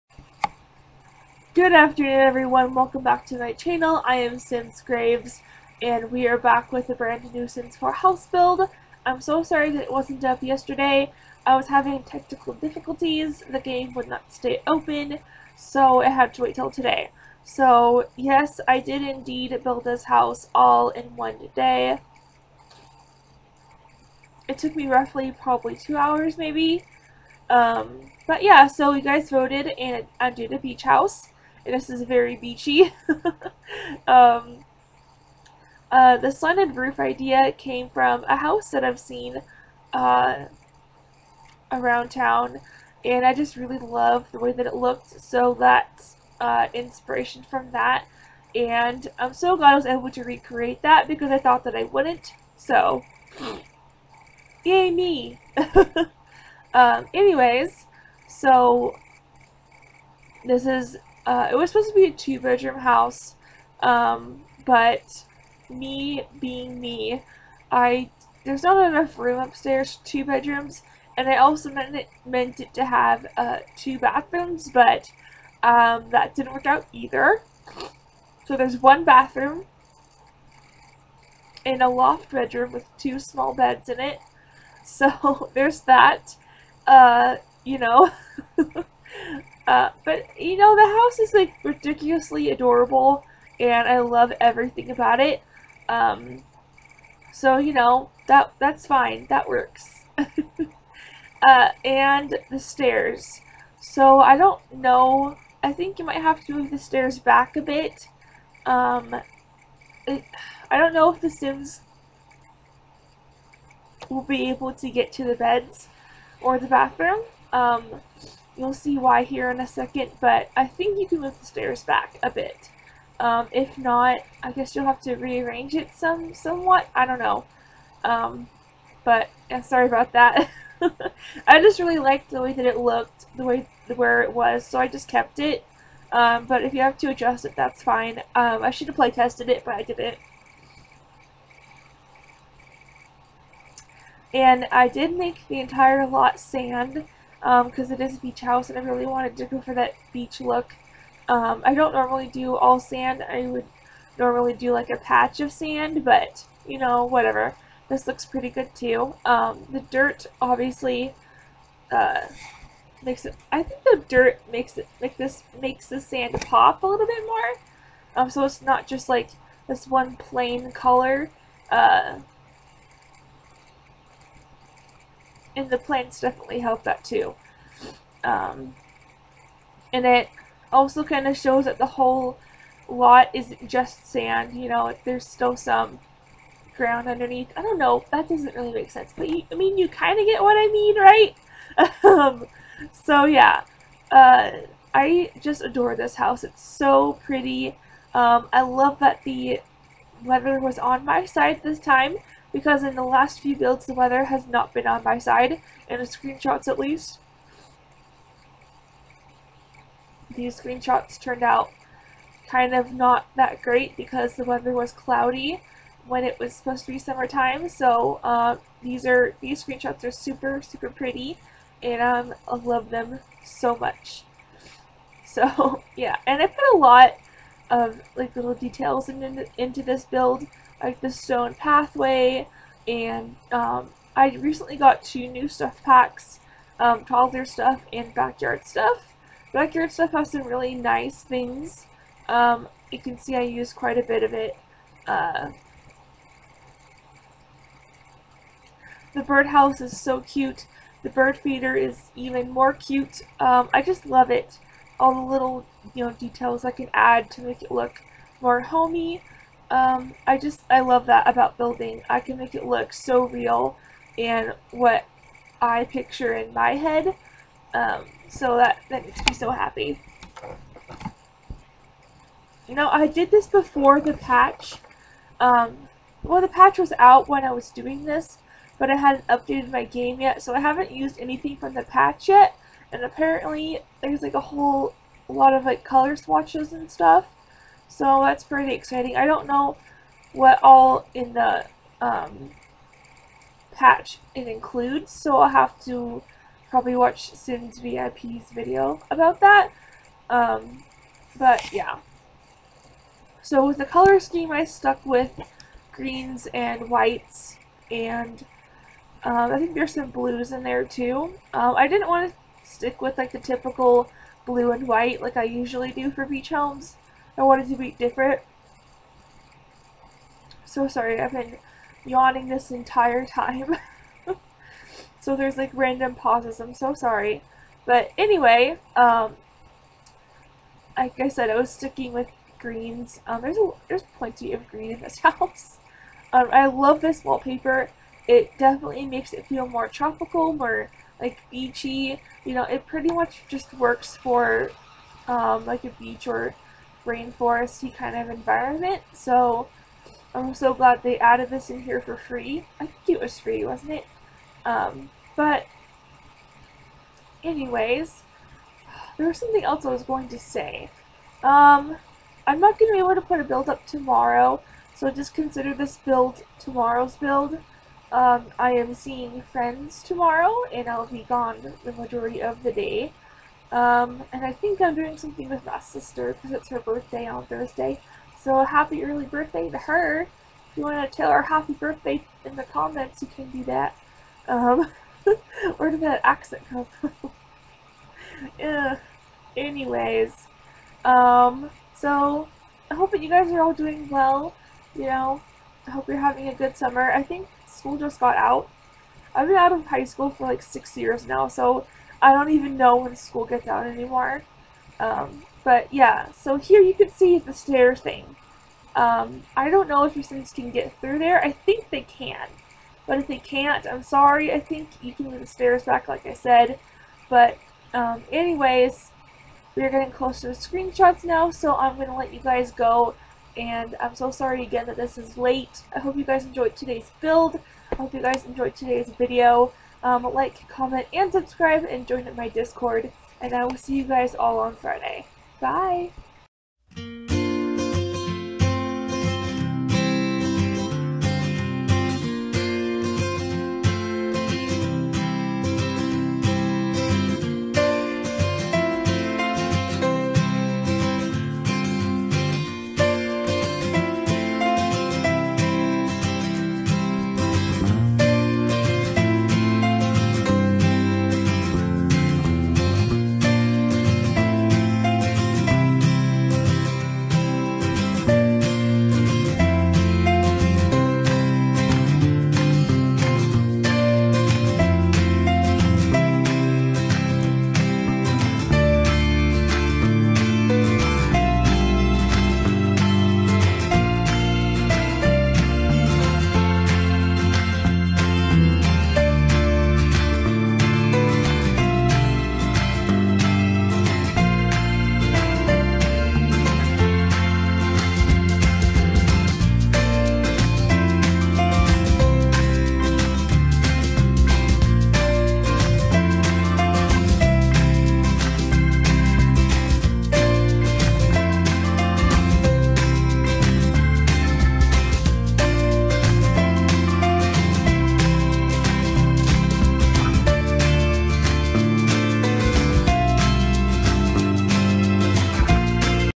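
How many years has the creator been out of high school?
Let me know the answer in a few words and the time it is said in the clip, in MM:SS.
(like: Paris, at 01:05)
6, at 06:40.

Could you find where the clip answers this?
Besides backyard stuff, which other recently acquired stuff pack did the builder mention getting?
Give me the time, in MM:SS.
03:57.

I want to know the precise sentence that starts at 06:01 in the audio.
Um, I'm not going to be able to put a build up tomorrow, so just consider this build tomorrow's build.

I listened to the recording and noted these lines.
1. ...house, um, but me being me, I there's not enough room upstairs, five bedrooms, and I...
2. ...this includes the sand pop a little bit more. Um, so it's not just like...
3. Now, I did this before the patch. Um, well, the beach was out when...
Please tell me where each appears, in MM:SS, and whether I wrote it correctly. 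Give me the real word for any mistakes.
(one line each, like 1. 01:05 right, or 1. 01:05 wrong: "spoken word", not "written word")
1. 01:02 wrong: "two", not "five"
2. 02:45 wrong: "makes", not "includes"
3. 04:32 wrong: "patch", not "beach".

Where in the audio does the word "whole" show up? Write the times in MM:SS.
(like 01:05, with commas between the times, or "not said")
03:01, 04:44.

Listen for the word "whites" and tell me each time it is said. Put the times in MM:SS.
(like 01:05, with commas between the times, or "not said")
05:06, 05:14.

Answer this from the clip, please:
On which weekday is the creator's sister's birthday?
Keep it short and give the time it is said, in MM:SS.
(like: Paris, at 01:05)
Thursday, at 06:17.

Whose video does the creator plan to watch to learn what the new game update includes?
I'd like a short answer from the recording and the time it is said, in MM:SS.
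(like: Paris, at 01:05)
Sims VIP, at 04:57.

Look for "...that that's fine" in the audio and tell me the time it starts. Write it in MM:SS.
01:38.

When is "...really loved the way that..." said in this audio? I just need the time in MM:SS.
00:43.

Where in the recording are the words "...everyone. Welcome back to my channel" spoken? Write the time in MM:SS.
00:02.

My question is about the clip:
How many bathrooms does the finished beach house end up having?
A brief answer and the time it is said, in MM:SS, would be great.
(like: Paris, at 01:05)
1, at 01:18.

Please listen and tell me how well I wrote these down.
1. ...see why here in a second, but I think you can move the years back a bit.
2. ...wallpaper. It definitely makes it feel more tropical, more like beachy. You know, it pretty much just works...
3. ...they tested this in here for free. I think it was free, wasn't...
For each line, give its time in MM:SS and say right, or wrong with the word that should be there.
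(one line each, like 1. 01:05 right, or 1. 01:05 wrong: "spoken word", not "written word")
1. 01:58 wrong: "stairs", not "years"
2. 05:37 right
3. 05:51 wrong: "added", not "tested".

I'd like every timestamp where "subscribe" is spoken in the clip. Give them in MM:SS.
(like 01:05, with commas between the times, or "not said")
07:11.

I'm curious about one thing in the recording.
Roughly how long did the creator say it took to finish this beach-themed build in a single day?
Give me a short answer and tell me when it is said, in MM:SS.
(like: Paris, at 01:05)
2 hours, at 00:25.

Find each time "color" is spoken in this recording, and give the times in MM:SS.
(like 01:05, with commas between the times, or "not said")
02:50, 04:45, 05:03.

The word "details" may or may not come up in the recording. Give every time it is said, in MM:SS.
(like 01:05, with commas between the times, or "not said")
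03:48, 04:16.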